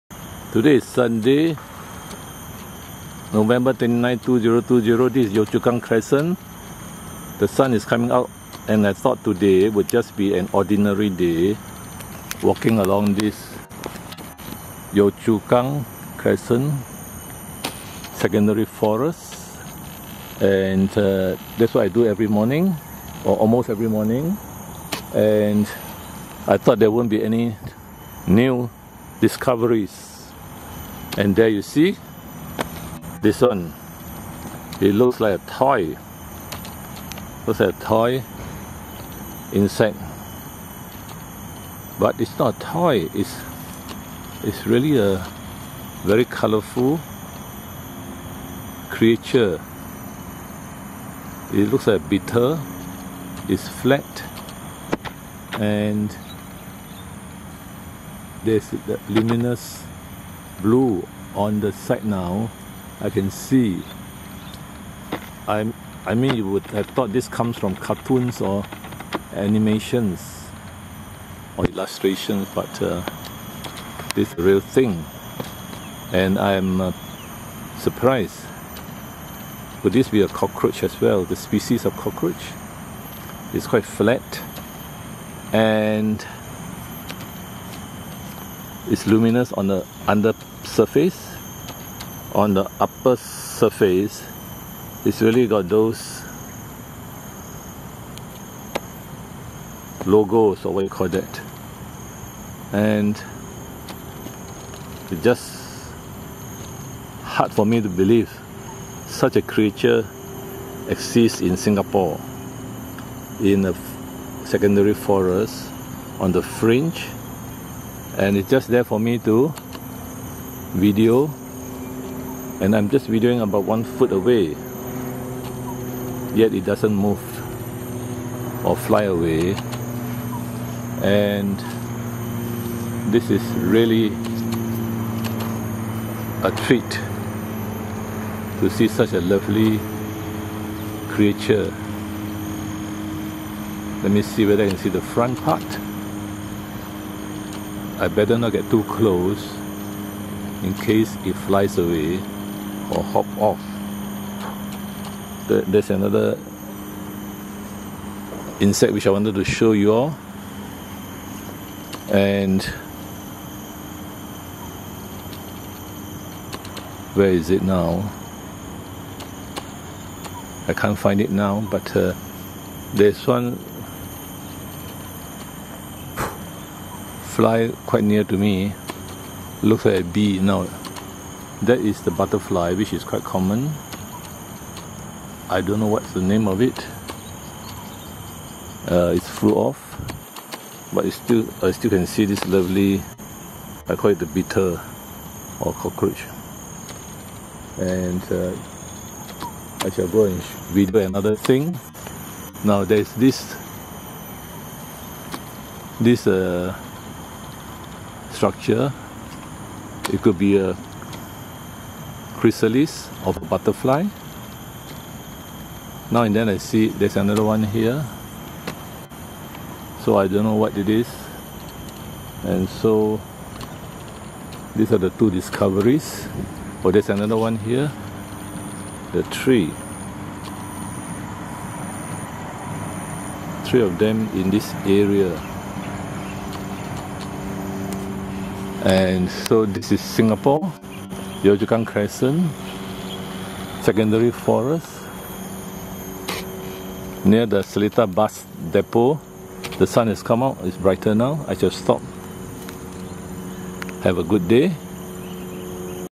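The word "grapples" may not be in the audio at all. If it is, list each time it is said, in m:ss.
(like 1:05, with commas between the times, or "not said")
not said.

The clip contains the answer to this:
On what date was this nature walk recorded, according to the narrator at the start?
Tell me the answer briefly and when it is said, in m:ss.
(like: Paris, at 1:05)
November 29, 2020, at 0:03.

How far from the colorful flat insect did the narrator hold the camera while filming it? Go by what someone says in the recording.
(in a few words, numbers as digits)
one foot.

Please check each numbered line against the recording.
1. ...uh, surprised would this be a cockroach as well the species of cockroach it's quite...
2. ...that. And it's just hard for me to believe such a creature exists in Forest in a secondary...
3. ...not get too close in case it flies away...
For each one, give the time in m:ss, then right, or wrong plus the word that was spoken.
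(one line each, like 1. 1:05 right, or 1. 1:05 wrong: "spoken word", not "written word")
1. 1:16 right
2. 1:41 wrong: "Singapore", not "Forest"
3. 2:28 right.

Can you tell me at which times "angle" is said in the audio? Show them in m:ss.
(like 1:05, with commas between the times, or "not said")
not said.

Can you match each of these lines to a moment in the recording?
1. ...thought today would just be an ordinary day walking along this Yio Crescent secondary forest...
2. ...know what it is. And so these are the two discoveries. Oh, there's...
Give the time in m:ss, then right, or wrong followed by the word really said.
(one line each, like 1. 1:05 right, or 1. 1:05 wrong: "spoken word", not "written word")
1. 0:08 right
2. 3:40 right.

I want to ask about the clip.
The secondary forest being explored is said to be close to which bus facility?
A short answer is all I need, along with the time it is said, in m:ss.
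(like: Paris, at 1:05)
Seletar Bus Depot, at 4:07.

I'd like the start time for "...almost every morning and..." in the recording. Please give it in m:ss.
0:23.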